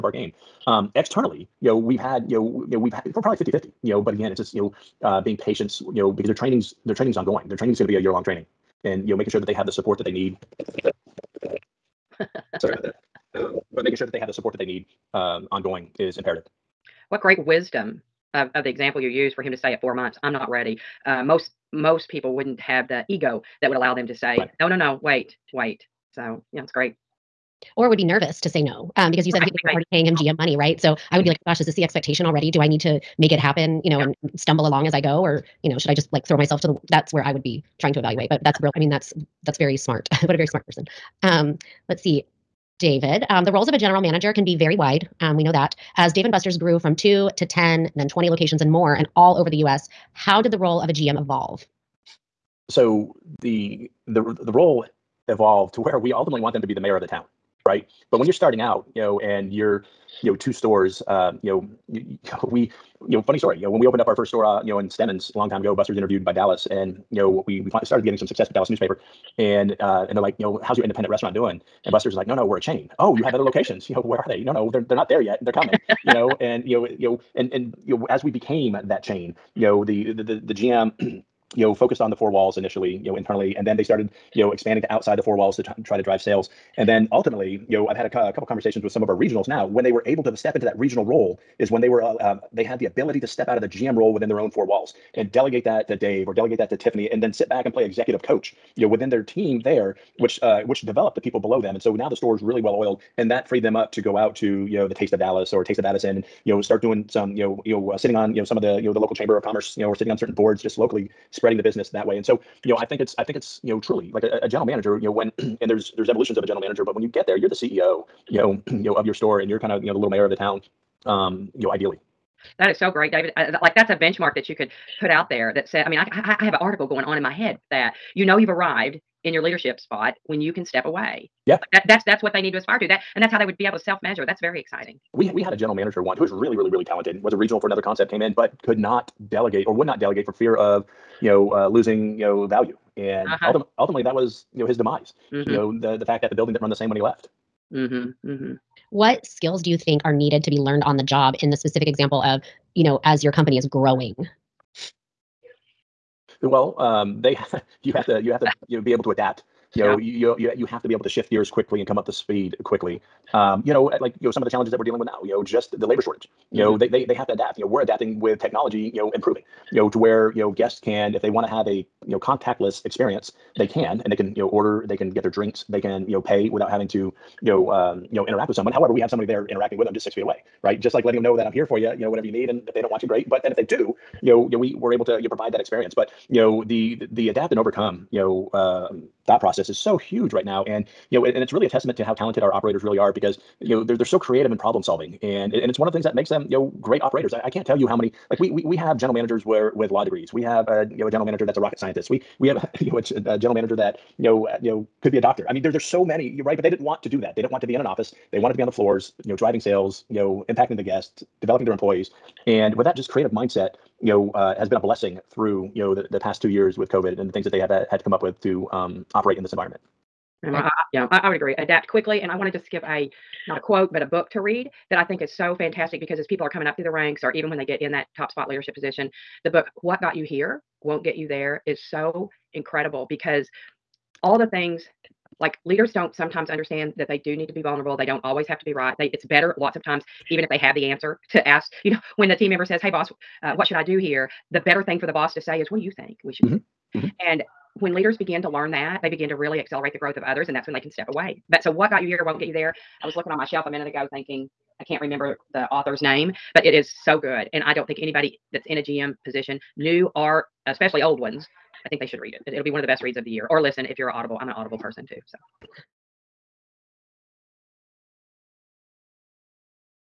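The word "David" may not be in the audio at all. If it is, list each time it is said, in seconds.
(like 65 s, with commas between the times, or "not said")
42 s, 123 s.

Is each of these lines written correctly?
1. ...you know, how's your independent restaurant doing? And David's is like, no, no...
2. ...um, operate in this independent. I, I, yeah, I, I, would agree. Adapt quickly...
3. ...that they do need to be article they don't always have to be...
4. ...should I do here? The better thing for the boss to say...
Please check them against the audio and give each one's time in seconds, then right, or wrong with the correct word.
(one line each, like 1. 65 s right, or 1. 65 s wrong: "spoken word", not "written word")
1. 70 s wrong: "Buster", not "David"
2. 218 s wrong: "environment", not "independent"
3. 236 s wrong: "vulnerable", not "article"
4. 243 s right.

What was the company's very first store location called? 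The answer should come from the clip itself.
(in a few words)
Stemmons.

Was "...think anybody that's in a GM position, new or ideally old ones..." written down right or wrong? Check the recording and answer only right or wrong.
wrong.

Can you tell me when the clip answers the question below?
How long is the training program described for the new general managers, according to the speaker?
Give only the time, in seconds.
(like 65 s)
7 s.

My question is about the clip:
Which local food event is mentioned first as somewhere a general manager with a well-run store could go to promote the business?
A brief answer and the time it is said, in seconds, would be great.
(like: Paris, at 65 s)
Taste of Dallas, at 104 s.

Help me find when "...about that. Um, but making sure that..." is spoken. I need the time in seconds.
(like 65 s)
12 s.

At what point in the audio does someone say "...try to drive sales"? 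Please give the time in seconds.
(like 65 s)
85 s.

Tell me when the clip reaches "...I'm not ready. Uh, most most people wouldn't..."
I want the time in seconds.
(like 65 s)
20 s.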